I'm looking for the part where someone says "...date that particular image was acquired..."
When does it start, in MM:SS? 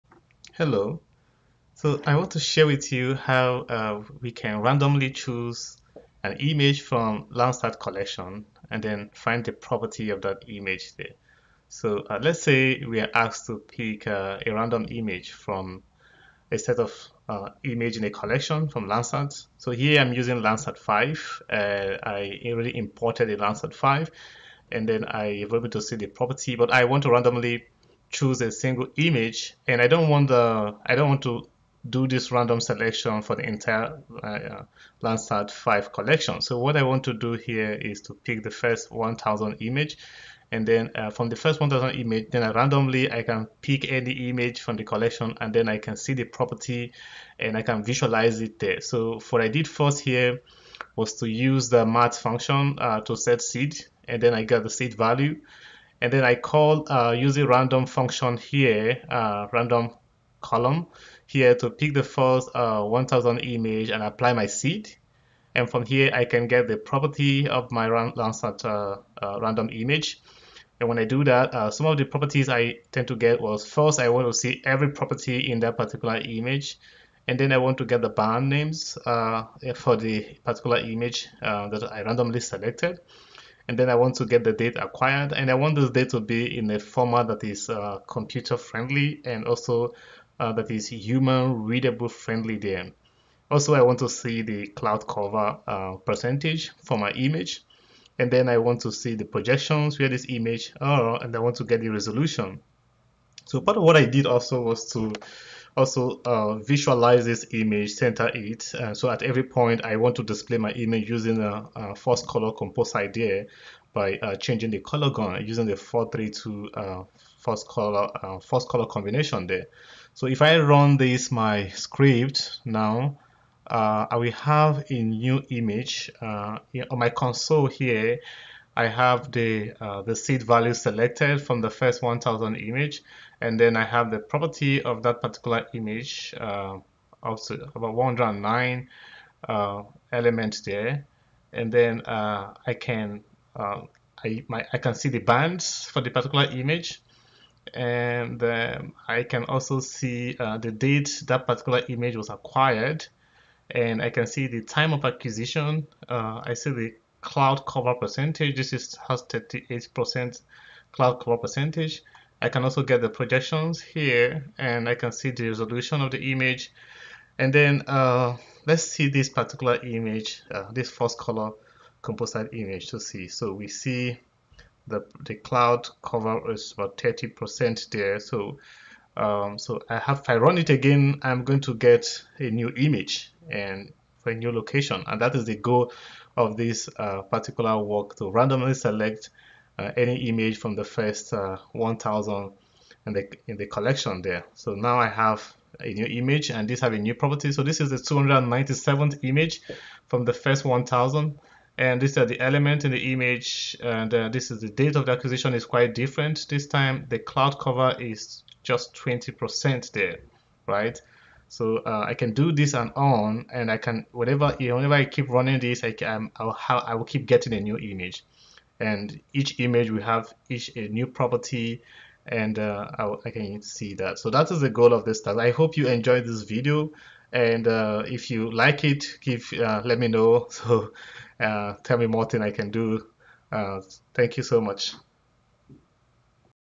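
02:30.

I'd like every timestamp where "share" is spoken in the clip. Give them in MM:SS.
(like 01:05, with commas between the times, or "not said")
00:02.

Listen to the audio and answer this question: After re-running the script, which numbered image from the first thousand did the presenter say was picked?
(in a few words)
297th.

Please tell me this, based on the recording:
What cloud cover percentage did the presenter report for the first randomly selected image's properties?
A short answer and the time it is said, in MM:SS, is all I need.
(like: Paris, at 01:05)
38%, at 02:39.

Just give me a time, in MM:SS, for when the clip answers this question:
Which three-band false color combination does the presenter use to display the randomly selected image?
01:55.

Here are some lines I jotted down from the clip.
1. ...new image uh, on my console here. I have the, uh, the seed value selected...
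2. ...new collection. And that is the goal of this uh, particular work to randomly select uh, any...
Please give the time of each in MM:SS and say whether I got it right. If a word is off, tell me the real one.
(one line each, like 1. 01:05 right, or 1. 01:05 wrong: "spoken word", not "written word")
1. 02:05 right
2. 03:04 wrong: "location", not "collection".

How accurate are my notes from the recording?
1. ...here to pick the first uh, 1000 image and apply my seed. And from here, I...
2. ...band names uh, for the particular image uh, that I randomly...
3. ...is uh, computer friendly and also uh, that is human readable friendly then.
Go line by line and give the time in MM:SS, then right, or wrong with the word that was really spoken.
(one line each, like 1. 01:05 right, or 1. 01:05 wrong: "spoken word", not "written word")
1. 01:01 right
2. 01:18 right
3. 01:27 right.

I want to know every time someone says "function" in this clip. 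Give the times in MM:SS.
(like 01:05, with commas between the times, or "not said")
00:52, 00:57.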